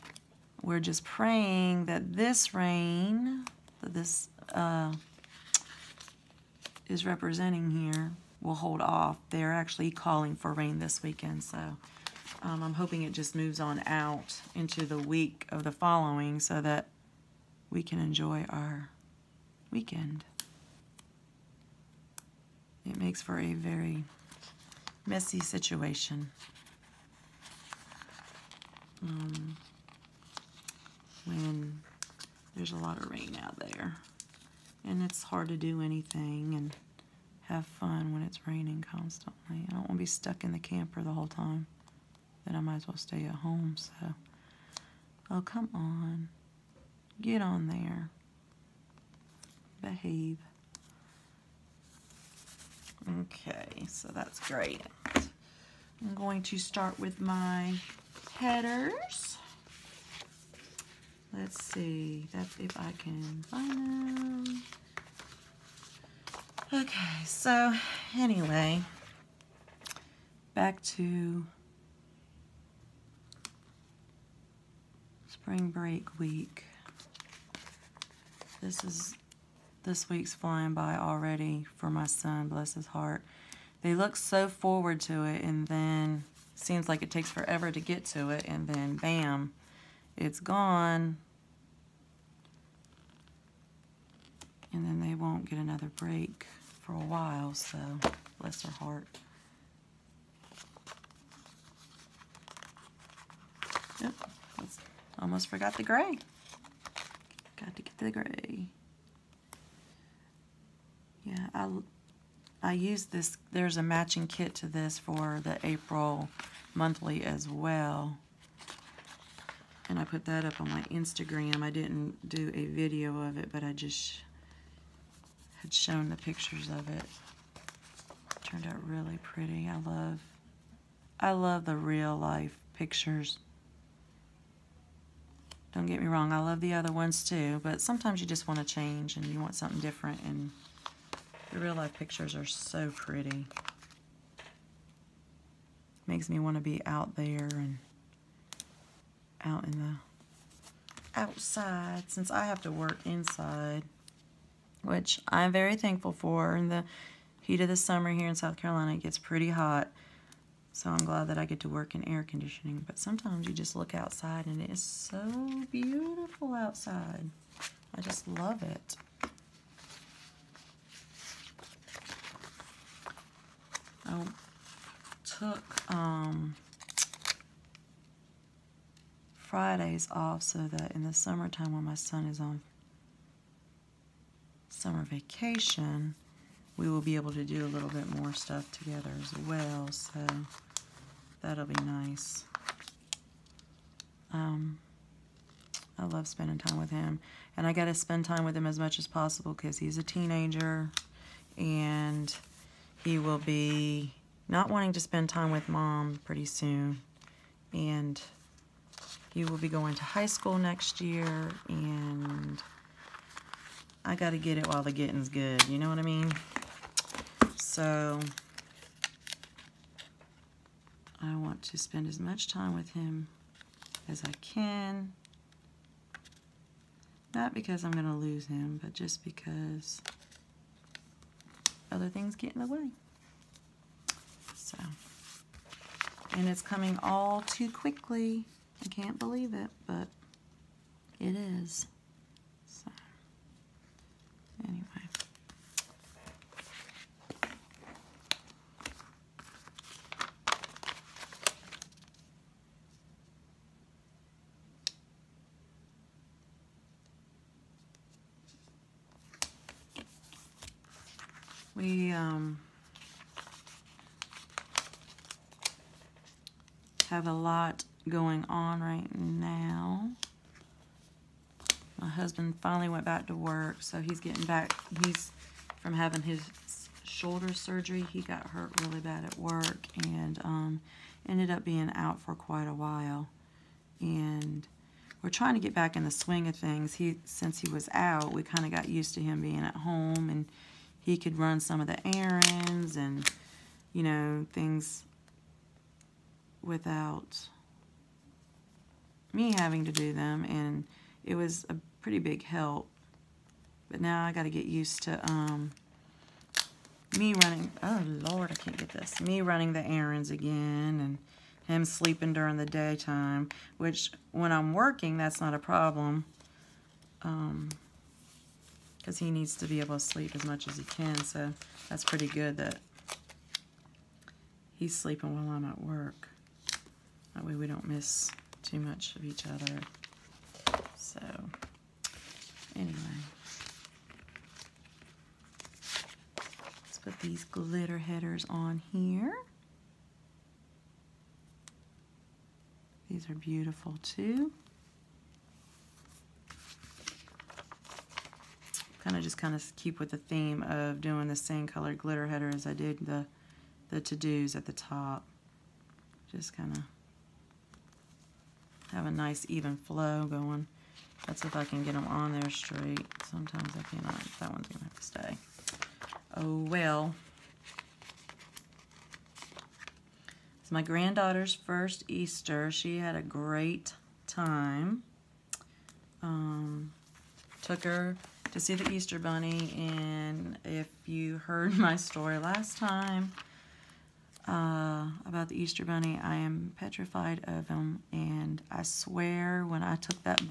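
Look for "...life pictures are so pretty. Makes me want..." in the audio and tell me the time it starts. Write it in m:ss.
2:21.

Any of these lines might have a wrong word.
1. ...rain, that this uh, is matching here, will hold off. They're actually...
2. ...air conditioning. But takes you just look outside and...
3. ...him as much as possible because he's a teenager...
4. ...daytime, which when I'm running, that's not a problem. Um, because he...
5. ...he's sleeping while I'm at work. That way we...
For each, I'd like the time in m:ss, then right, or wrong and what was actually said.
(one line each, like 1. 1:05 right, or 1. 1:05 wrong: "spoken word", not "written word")
1. 0:02 wrong: "representing", not "matching"
2. 2:42 wrong: "sometimes", not "takes"
3. 3:18 right
4. 5:12 wrong: "working", not "running"
5. 5:24 right.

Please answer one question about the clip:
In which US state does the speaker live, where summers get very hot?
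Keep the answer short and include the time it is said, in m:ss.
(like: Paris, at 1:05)
South Carolina, at 2:38.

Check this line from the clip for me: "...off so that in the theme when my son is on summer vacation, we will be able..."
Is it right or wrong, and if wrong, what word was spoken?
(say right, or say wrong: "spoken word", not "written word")
wrong: "summertime", not "theme".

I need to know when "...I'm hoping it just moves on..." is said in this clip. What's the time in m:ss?
0:12.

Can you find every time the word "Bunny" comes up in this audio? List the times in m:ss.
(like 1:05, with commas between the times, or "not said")
6:19, 6:25.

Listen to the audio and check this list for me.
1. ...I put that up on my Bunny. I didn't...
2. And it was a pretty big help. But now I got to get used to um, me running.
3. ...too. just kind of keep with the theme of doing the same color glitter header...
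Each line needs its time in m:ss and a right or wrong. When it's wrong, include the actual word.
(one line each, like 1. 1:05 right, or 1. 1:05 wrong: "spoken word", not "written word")
1. 1:59 wrong: "Instagram", not "Bunny"
2. 5:00 right
3. 5:44 right.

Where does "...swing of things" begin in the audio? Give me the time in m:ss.
4:46.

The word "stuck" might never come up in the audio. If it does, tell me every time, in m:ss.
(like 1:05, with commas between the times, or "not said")
0:40.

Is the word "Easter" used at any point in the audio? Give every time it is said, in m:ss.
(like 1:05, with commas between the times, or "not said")
6:12, 6:18, 6:25.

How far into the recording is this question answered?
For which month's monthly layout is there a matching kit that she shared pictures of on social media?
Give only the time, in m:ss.
1:55.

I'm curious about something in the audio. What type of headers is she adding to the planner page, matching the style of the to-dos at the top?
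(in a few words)
Glitter headers.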